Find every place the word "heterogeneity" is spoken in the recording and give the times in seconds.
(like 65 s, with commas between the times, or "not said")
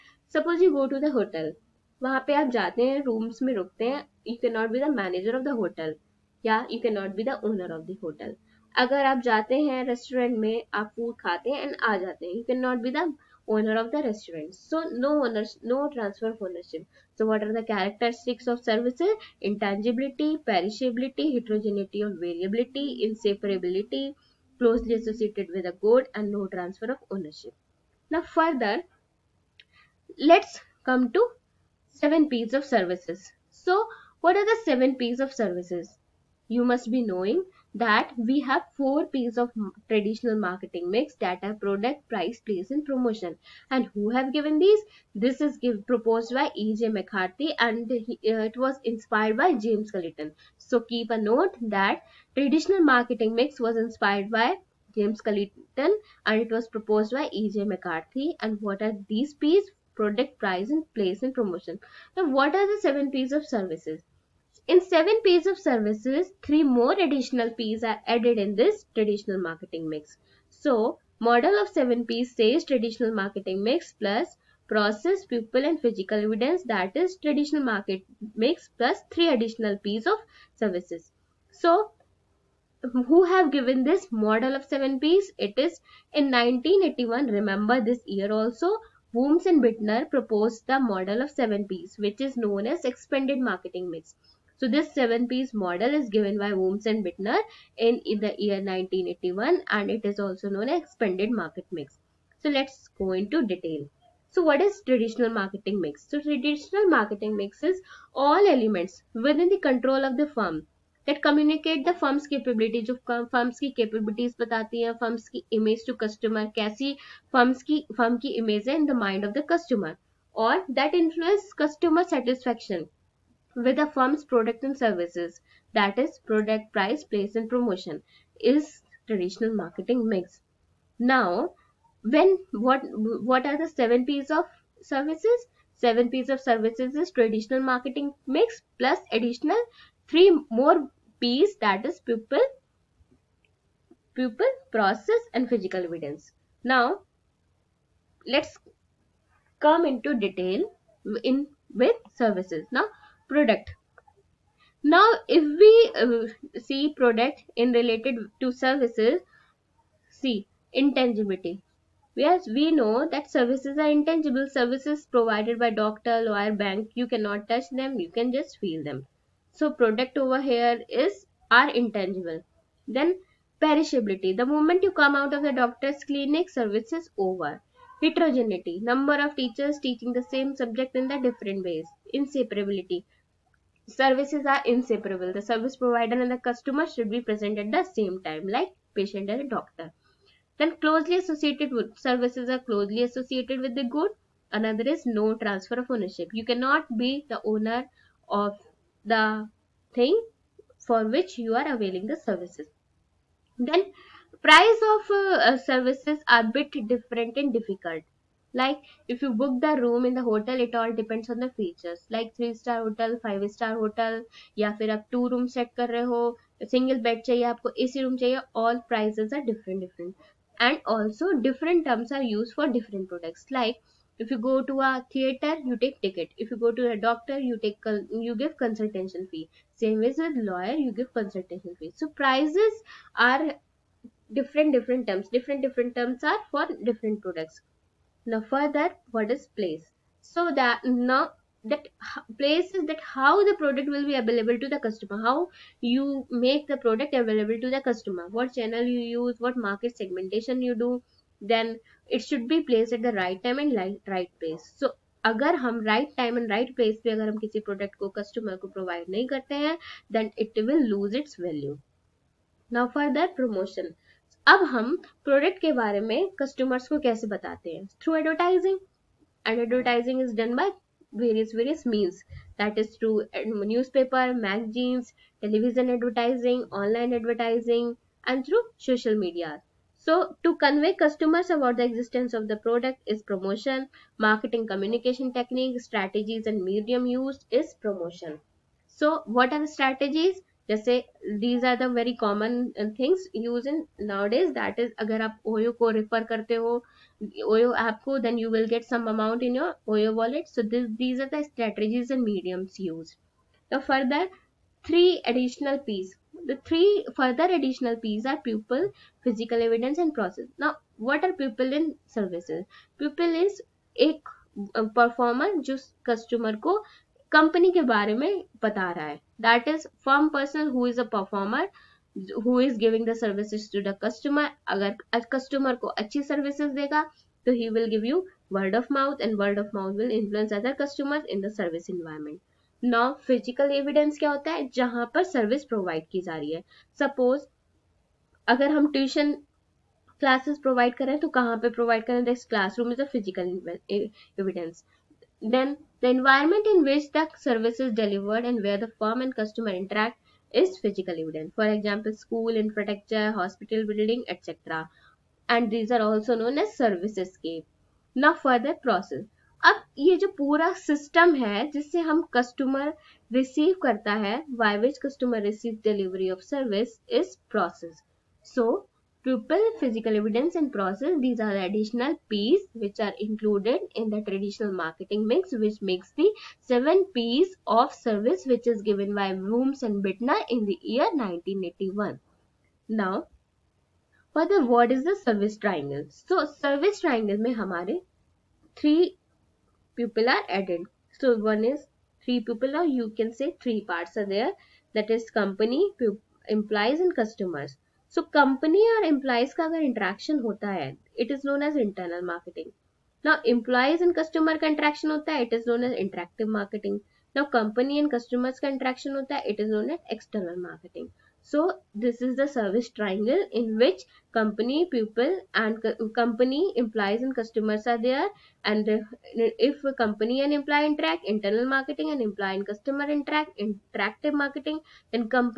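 21 s, 178 s.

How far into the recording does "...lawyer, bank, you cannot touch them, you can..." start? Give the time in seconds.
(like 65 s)
166 s.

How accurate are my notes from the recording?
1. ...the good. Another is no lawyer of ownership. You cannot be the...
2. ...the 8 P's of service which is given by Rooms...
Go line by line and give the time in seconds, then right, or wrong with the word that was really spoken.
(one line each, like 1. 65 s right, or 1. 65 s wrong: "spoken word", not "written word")
1. 193 s wrong: "transfer", not "lawyer"
2. 376 s wrong: "7", not "8".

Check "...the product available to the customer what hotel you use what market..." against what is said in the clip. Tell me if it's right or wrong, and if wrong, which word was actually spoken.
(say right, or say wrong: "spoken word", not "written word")
wrong: "channel", not "hotel".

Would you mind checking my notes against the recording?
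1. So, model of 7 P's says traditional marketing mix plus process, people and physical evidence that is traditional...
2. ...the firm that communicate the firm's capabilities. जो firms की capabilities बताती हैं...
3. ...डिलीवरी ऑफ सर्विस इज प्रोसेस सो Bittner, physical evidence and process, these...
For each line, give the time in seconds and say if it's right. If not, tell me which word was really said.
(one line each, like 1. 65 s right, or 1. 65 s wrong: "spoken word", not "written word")
1. 70 s right
2. 110 s right
3. 365 s wrong: "Pupil", not "Bittner".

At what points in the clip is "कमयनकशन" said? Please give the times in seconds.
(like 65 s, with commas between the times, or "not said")
284 s.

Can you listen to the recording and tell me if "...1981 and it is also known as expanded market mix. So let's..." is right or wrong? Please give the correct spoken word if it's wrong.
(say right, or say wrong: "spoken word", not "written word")
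right.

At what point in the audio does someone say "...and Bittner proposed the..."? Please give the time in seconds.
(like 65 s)
89 s.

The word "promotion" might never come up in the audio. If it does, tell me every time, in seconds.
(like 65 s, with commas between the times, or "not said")
42 s, 61 s, 127 s.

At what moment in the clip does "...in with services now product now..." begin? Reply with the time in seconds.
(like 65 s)
151 s.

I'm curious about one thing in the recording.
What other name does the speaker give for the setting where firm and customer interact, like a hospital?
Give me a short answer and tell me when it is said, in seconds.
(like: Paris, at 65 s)
Service escape, at 355 s.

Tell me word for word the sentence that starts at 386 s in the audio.
So, service triangle में हमारे three pupil are added.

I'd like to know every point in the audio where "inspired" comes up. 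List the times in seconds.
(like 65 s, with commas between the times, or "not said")
48 s, 53 s.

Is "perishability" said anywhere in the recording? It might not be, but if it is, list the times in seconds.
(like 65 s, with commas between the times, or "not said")
20 s, 173 s.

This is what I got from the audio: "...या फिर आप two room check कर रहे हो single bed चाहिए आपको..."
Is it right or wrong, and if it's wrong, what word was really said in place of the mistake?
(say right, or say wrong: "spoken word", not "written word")
right.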